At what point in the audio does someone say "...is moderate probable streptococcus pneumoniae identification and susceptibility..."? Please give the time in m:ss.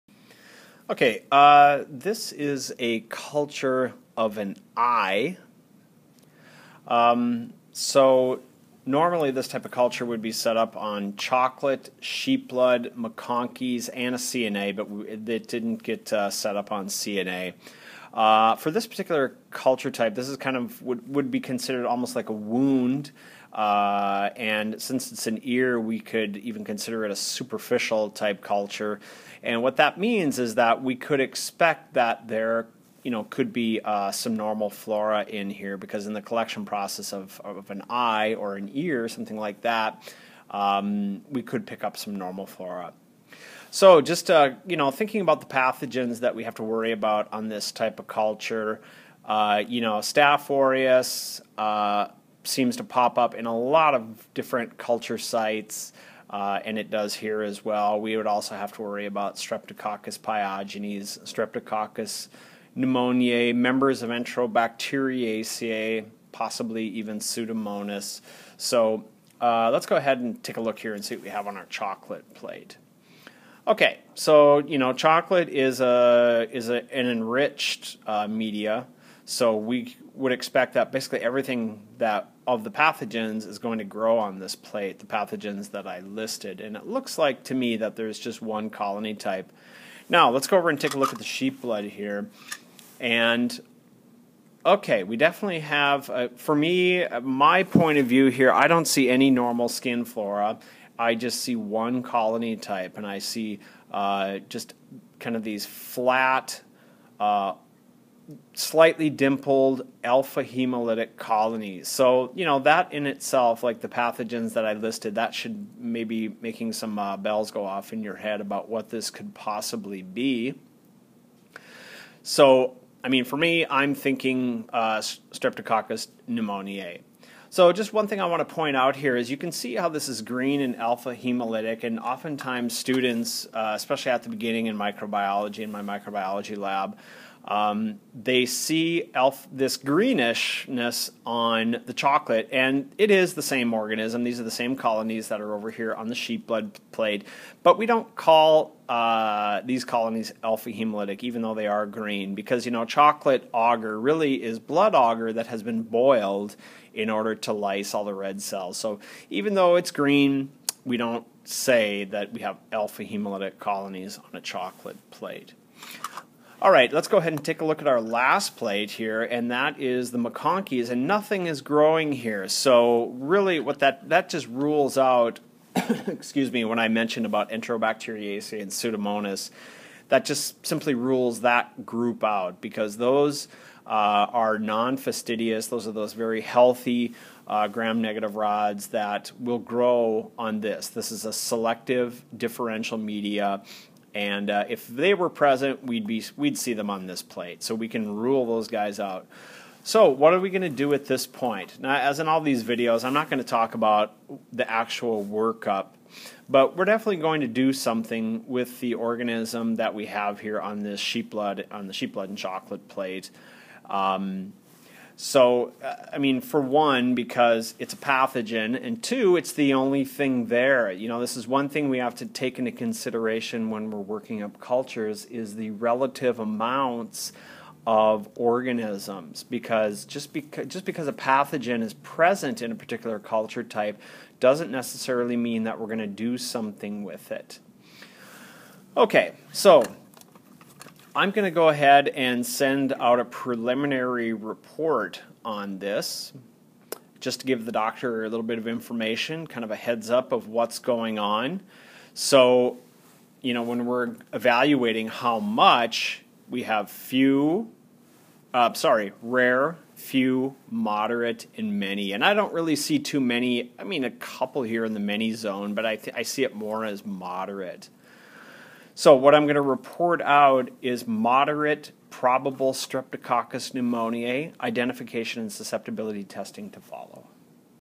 4:30.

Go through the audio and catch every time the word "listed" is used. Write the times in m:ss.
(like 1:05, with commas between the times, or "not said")
1:25, 1:54.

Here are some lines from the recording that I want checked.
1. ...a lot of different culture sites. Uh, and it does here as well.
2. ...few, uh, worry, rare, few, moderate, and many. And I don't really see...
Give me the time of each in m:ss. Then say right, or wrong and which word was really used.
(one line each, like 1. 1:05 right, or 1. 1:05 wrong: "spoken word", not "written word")
1. 0:53 right
2. 4:16 wrong: "sorry", not "worry".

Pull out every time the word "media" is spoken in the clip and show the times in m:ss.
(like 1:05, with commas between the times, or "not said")
1:18, 3:12.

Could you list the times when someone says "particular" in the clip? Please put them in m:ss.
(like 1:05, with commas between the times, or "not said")
0:18, 3:52.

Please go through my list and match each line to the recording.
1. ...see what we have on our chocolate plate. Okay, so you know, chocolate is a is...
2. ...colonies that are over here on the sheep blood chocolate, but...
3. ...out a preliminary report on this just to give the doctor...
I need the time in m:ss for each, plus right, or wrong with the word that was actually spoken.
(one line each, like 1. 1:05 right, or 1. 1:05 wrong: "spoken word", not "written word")
1. 1:11 right
2. 2:24 wrong: "plate", not "chocolate"
3. 4:02 right.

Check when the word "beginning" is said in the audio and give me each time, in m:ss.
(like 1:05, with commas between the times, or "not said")
2:14.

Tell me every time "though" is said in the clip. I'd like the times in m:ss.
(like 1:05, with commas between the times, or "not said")
2:31, 2:39.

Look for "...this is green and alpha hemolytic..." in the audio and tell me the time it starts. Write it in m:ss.
2:09.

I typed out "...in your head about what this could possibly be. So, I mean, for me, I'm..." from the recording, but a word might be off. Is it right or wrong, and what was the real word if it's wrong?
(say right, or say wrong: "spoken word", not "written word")
right.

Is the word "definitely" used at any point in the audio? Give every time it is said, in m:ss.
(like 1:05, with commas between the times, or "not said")
1:35, 3:26.